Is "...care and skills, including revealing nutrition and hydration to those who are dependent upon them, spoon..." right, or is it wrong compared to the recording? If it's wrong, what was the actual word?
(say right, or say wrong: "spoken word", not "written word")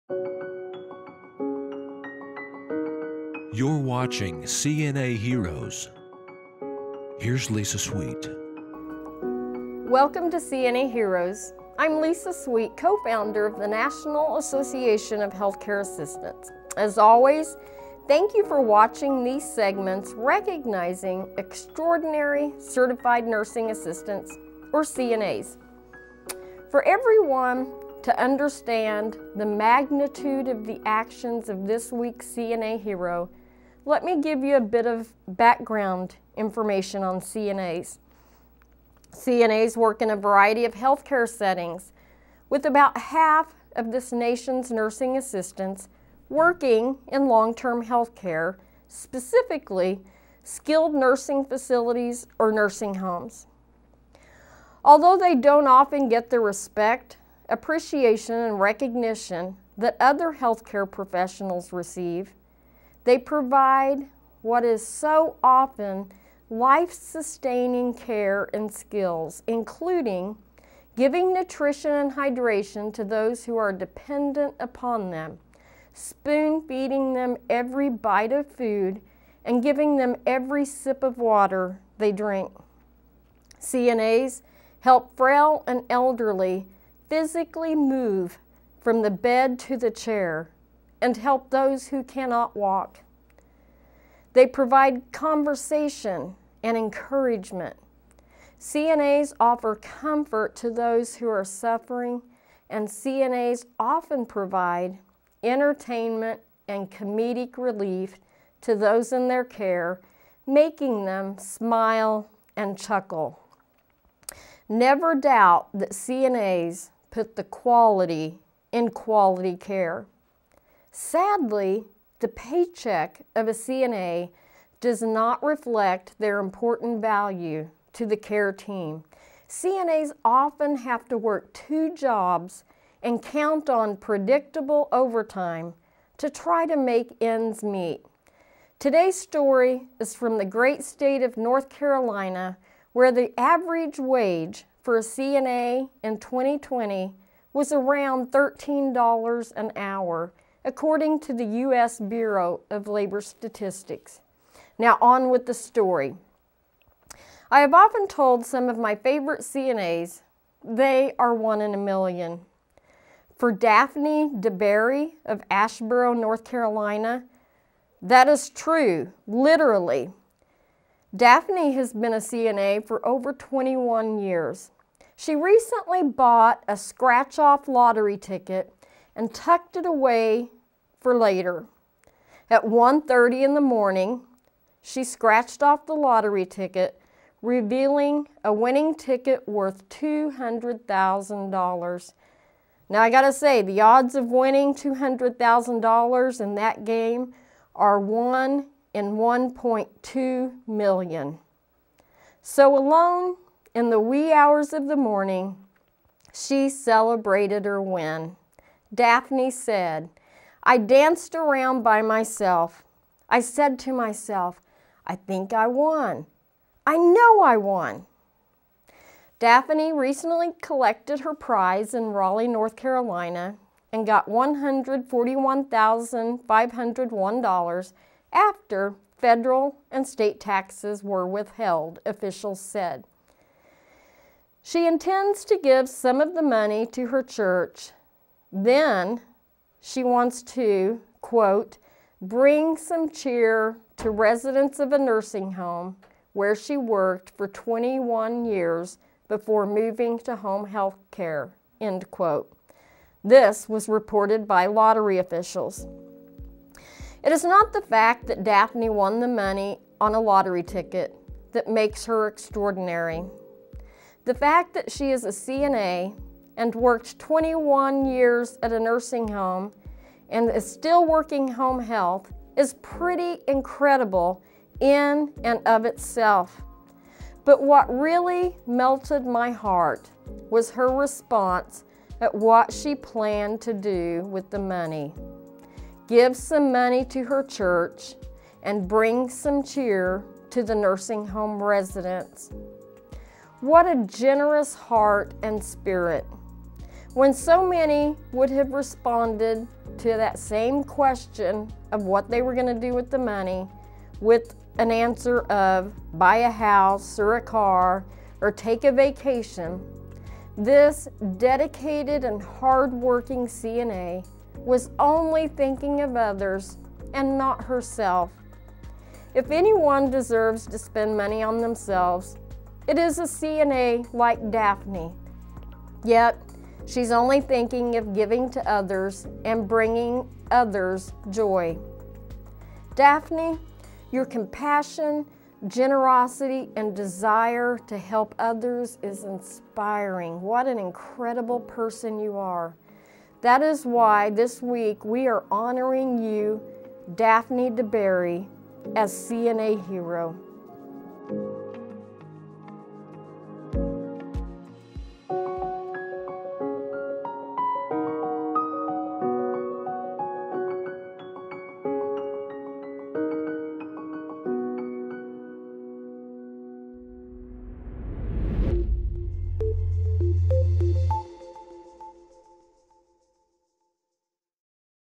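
wrong: "giving", not "revealing".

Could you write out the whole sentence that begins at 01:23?
CNAs help frail and elderly physically move from the bed to the chair and help those who cannot walk.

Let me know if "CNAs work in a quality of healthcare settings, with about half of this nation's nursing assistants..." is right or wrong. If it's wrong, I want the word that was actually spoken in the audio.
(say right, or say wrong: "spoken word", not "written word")
wrong: "variety", not "quality".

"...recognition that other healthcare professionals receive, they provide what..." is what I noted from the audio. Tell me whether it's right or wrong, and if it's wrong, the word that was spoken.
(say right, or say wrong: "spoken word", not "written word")
right.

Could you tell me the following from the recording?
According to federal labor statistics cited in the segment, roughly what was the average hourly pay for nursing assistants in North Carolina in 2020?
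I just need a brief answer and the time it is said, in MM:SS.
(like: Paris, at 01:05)
$13 an hour, at 02:28.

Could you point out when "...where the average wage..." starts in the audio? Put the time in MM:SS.
02:22.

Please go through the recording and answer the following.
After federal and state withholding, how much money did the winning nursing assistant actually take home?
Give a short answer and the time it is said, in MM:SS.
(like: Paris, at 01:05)
$141,501, at 03:44.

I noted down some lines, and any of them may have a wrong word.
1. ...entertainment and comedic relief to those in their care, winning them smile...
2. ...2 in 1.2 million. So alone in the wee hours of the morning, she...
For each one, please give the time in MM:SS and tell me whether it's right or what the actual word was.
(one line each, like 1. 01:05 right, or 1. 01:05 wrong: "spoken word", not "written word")
1. 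01:45 wrong: "making", not "winning"
2. 03:17 wrong: "1", not "2".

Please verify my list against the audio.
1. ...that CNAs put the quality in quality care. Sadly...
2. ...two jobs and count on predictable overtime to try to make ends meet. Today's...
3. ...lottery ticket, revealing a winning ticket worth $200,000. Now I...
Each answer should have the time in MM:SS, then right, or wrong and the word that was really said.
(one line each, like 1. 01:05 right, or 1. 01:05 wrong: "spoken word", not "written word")
1. 01:55 right
2. 02:11 right
3. 03:05 right.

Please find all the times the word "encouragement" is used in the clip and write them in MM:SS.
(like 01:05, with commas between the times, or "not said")
01:36.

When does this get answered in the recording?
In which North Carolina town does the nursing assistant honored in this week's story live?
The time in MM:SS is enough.
02:45.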